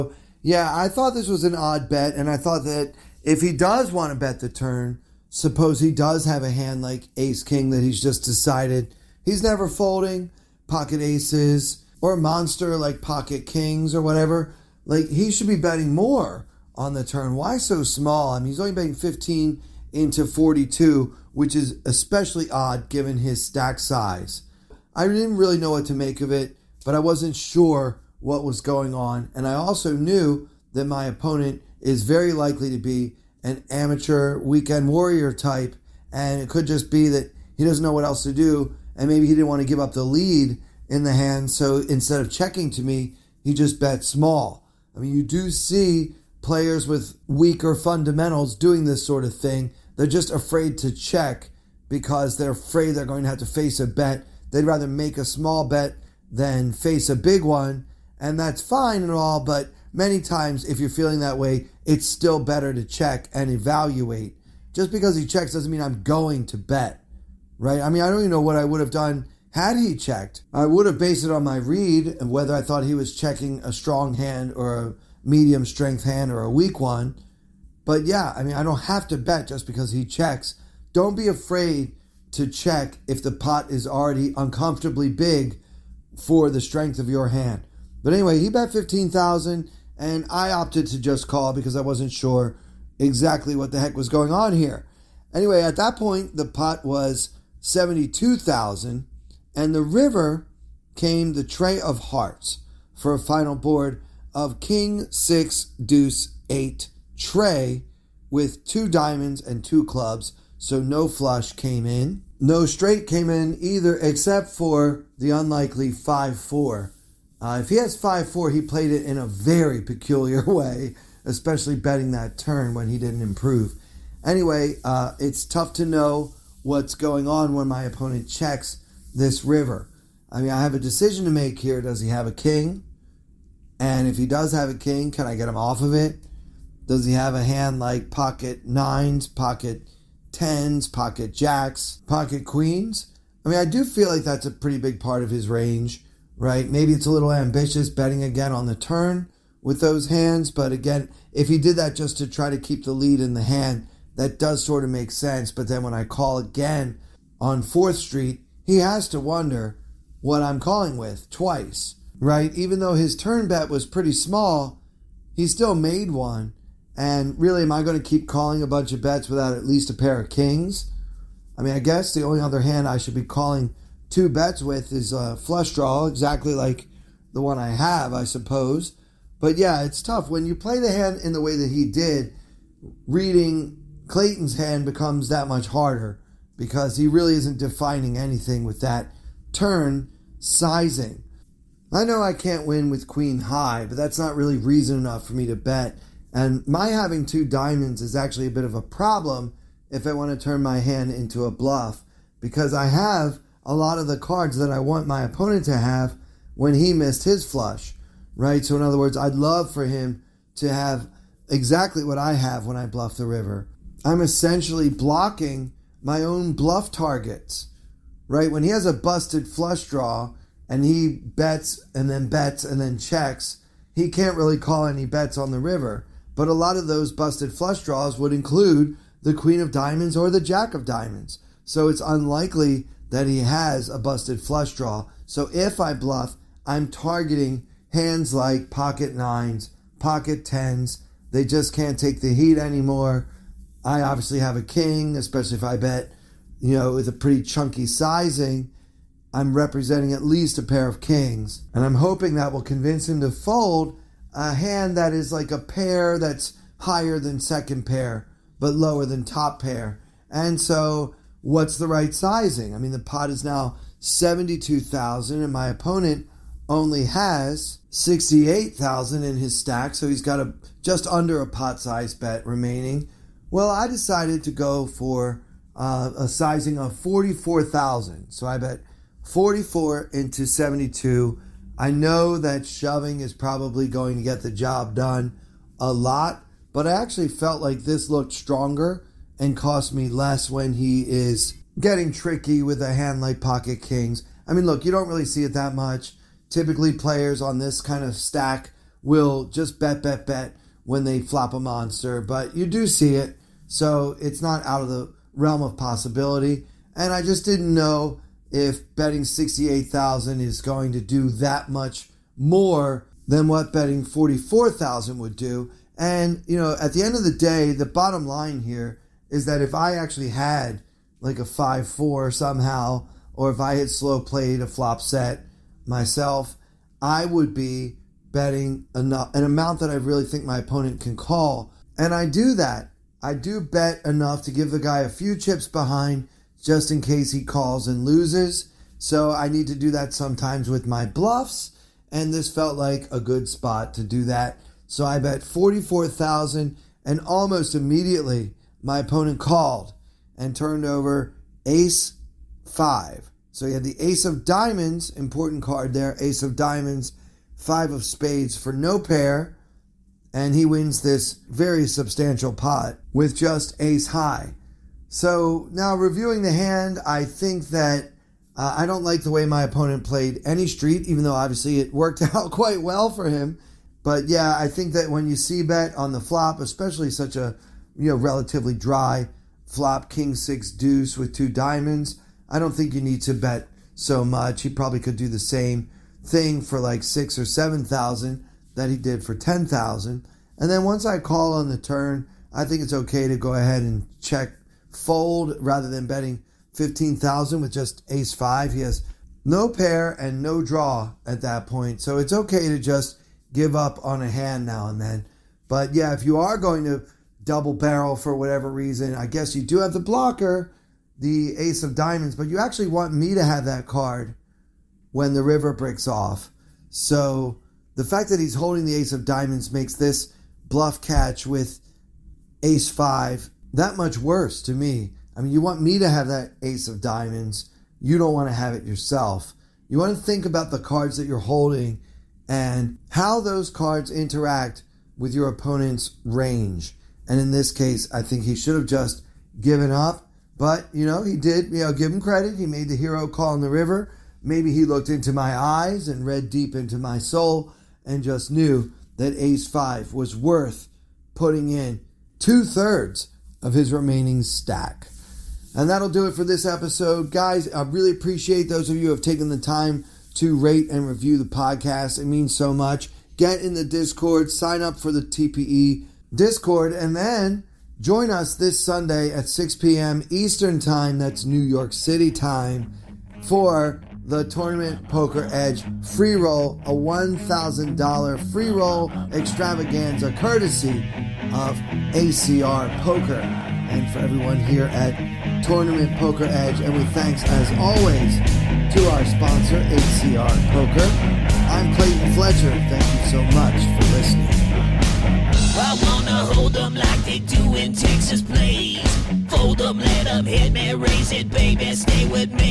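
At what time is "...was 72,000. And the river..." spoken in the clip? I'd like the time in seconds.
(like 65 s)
96 s.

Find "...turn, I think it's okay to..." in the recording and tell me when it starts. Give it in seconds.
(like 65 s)
391 s.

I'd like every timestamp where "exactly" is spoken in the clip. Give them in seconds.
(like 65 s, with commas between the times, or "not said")
92 s, 176 s, 211 s.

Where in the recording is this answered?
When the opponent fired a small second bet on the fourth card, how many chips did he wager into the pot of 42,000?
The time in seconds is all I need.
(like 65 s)
18 s.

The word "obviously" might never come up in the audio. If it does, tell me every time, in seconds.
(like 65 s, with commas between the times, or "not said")
244 s, 371 s.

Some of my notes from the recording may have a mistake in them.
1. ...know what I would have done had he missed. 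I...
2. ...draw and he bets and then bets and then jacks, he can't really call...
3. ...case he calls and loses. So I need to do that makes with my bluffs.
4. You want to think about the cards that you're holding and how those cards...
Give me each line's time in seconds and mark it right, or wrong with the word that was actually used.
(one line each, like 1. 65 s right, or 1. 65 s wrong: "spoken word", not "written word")
1. 68 s wrong: "checked", not "missed"
2. 219 s wrong: "checks", not "jacks"
3. 337 s wrong: "sometimes", not "makes"
4. 429 s right.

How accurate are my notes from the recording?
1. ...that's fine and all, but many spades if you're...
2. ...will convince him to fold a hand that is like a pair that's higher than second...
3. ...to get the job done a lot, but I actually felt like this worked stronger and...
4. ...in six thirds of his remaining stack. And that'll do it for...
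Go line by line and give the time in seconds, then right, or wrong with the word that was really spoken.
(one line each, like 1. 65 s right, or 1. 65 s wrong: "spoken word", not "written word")
1. 58 s wrong: "times", not "spades"
2. 252 s right
3. 284 s wrong: "looked", not "worked"
4. 451 s wrong: "two", not "six".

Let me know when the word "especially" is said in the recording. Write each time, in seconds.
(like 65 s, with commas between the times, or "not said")
21 s, 121 s, 245 s, 376 s.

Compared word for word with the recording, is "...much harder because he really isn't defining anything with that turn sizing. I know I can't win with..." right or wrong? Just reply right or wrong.
right.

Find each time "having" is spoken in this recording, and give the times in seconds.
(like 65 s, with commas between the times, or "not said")
196 s.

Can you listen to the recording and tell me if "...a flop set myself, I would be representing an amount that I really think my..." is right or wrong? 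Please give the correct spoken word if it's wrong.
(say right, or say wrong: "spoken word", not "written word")
wrong: "betting", not "representing".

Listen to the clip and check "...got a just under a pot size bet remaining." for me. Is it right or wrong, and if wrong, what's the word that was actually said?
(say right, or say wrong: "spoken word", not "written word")
right.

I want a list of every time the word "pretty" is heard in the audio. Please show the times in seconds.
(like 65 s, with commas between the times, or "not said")
144 s, 163 s, 247 s.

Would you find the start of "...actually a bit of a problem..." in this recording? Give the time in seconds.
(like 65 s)
198 s.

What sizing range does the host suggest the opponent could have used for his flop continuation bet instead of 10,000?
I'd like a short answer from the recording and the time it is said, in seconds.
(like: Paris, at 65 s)
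6,000 or 7,000, at 387 s.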